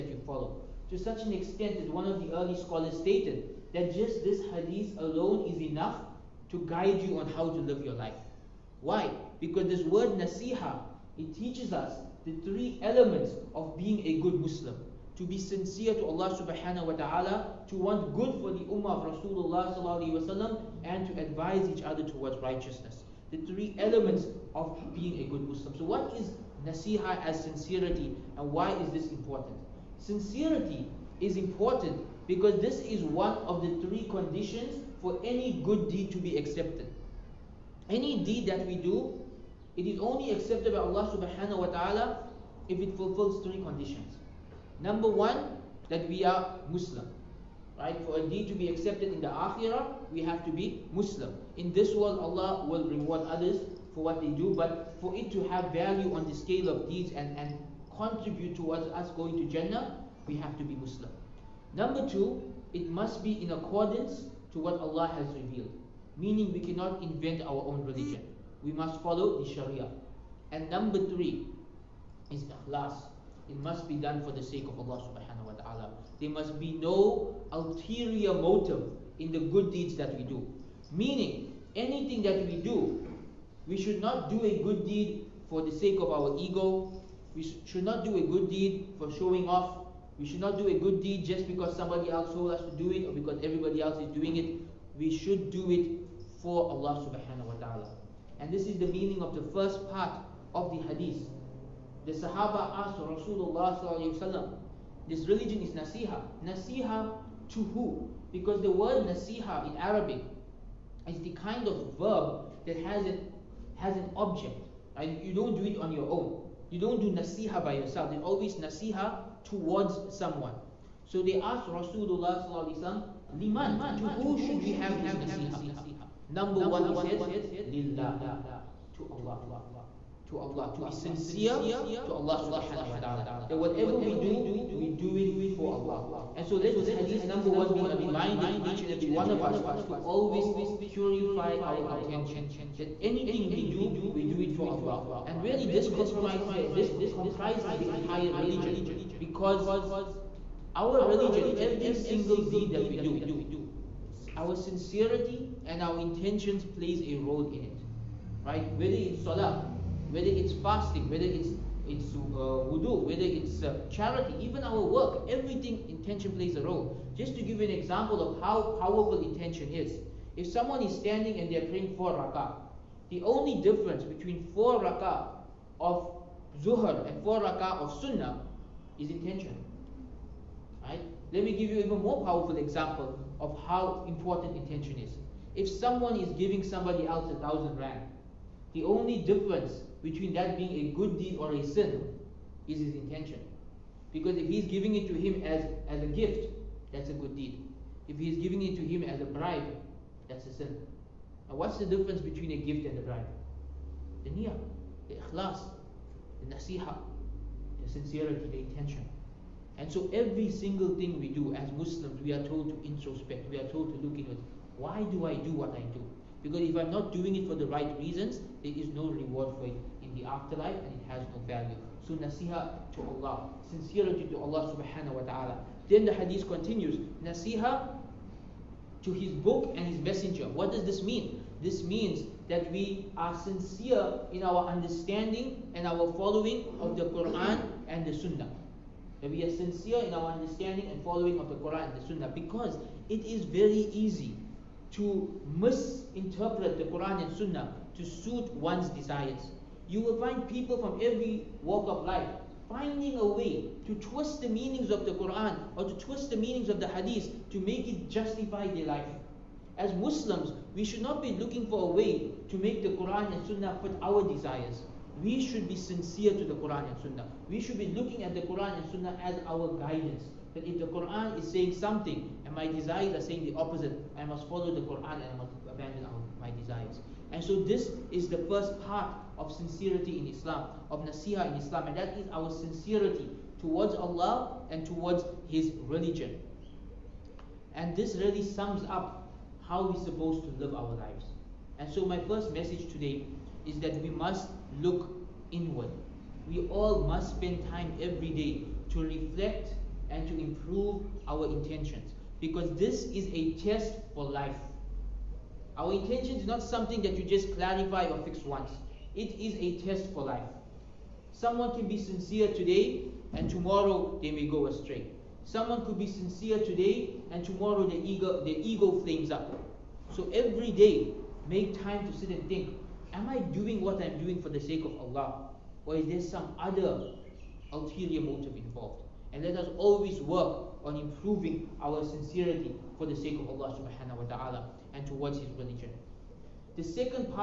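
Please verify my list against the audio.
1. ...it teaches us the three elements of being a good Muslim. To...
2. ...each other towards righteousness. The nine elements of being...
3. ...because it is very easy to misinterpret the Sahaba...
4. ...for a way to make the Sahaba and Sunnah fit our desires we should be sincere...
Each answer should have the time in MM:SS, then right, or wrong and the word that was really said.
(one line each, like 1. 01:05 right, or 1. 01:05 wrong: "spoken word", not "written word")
1. 00:11 right
2. 00:21 wrong: "three", not "nine"
3. 04:02 wrong: "Quran", not "Sahaba"
4. 04:21 wrong: "Quran", not "Sahaba".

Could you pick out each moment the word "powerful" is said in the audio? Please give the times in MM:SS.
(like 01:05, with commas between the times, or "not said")
02:48, 03:02.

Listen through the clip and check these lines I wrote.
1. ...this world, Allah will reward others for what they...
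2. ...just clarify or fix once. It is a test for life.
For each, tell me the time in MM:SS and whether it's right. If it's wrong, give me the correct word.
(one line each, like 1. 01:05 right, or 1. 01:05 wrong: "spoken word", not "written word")
1. 00:51 right
2. 05:07 right.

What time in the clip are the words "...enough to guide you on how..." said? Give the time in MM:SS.
00:05.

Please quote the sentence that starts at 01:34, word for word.
We should do it for Allah subhanahu wa ta'ala.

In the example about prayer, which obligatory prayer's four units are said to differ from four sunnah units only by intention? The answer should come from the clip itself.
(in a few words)
Zuhr.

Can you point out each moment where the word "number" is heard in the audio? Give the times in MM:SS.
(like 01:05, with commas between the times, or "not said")
00:44, 01:01, 01:10, 02:06, 02:17.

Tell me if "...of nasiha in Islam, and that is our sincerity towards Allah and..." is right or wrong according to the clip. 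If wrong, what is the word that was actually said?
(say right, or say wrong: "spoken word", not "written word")
right.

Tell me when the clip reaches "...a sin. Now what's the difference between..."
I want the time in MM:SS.
03:20.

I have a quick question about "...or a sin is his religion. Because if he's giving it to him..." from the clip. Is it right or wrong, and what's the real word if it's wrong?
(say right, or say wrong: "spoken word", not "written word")
wrong: "intention", not "religion".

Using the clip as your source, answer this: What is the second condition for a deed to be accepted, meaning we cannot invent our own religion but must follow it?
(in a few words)
the Sharia.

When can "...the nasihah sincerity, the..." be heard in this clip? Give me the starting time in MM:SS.
03:26.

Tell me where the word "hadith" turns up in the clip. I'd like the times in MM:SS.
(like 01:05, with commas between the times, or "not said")
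00:04, 01:40, 02:16, 03:46, 04:16.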